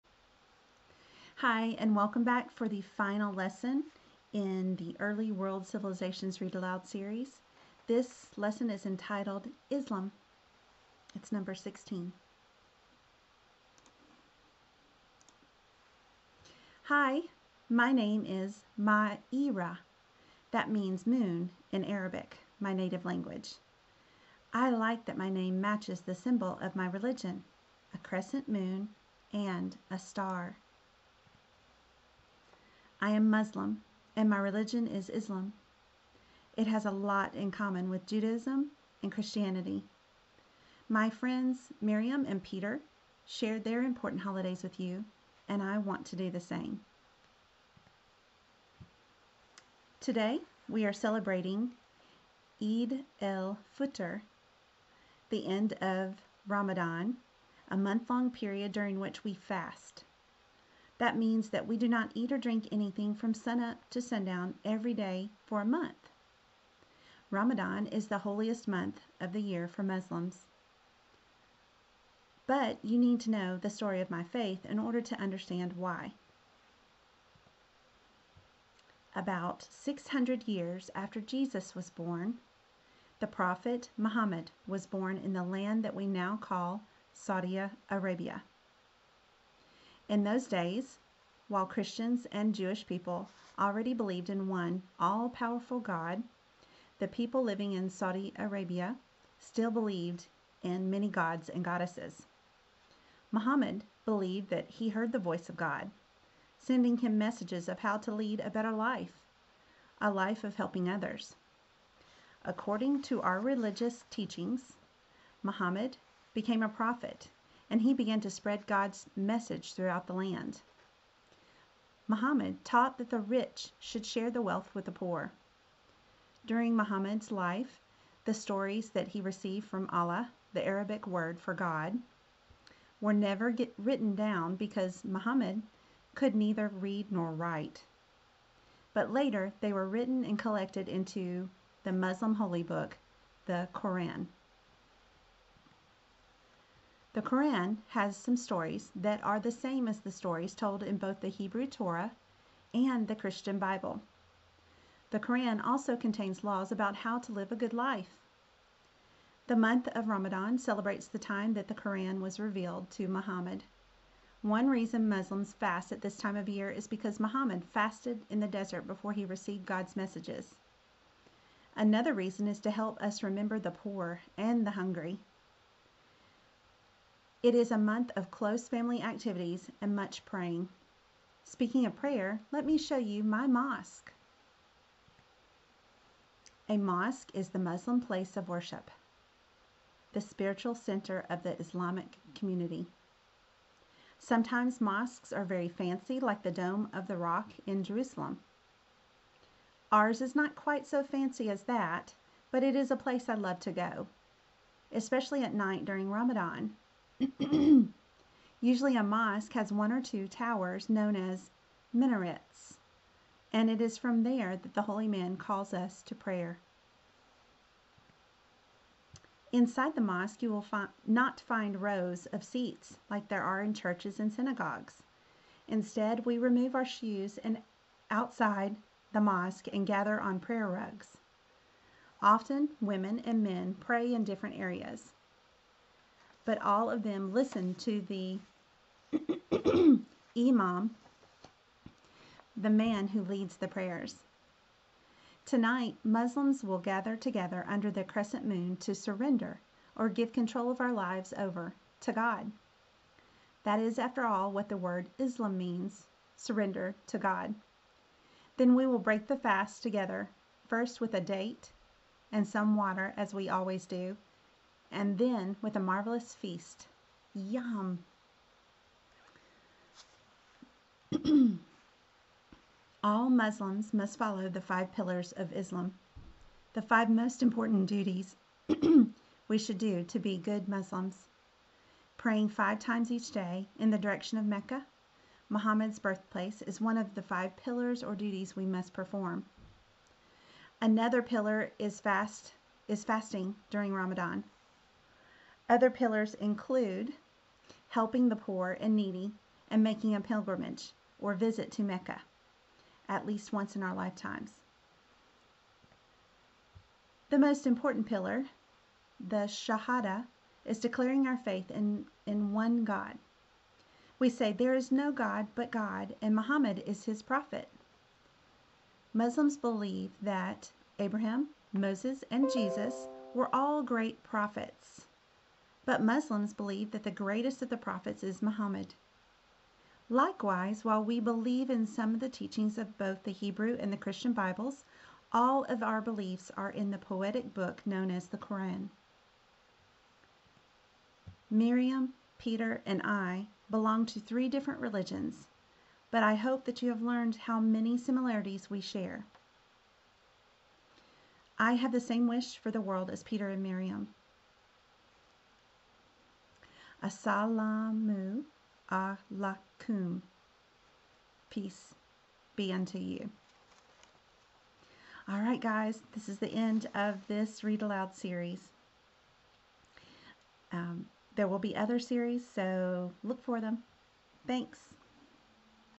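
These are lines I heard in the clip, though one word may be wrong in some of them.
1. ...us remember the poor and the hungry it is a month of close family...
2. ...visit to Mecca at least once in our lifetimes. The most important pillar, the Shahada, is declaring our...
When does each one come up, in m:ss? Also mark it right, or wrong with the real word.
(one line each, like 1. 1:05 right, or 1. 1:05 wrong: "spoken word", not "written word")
1. 2:53 right
2. 5:01 right.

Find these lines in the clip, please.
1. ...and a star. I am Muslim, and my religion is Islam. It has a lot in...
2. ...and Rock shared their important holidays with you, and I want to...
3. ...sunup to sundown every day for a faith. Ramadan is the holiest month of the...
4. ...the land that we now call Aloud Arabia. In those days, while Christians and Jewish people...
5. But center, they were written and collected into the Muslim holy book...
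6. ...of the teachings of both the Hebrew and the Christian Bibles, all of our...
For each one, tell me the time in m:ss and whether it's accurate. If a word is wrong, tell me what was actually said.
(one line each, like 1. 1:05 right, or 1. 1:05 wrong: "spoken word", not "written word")
1. 0:29 right
2. 0:42 wrong: "Peter", not "Rock"
3. 1:03 wrong: "month", not "faith"
4. 1:25 wrong: "Saudi", not "Aloud"
5. 2:18 wrong: "later", not "center"
6. 5:32 right.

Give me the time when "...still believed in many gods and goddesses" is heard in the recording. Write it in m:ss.
1:39.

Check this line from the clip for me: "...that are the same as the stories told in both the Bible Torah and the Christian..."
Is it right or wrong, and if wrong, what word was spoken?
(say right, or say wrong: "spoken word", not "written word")
wrong: "Hebrew", not "Bible".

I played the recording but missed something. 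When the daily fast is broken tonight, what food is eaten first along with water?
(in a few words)
A date.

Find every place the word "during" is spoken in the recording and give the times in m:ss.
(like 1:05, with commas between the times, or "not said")
0:58, 2:06, 3:25, 4:53.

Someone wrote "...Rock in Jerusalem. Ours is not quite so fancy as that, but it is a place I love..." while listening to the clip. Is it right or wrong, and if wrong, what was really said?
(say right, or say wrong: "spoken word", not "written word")
right.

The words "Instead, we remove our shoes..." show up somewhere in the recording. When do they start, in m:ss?
3:45.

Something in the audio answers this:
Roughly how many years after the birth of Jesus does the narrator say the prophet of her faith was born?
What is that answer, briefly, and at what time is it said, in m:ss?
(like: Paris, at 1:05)
600, at 1:19.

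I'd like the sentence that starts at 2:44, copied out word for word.
One reason Muslims fast at this time of year is because Muhammad fasted in the desert before he received God's messages.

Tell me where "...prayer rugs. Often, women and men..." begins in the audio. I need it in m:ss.
3:50.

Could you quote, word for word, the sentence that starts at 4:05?
Tonight, Muslims will gather together under the crescent moon to surrender or give control of our lives over to God.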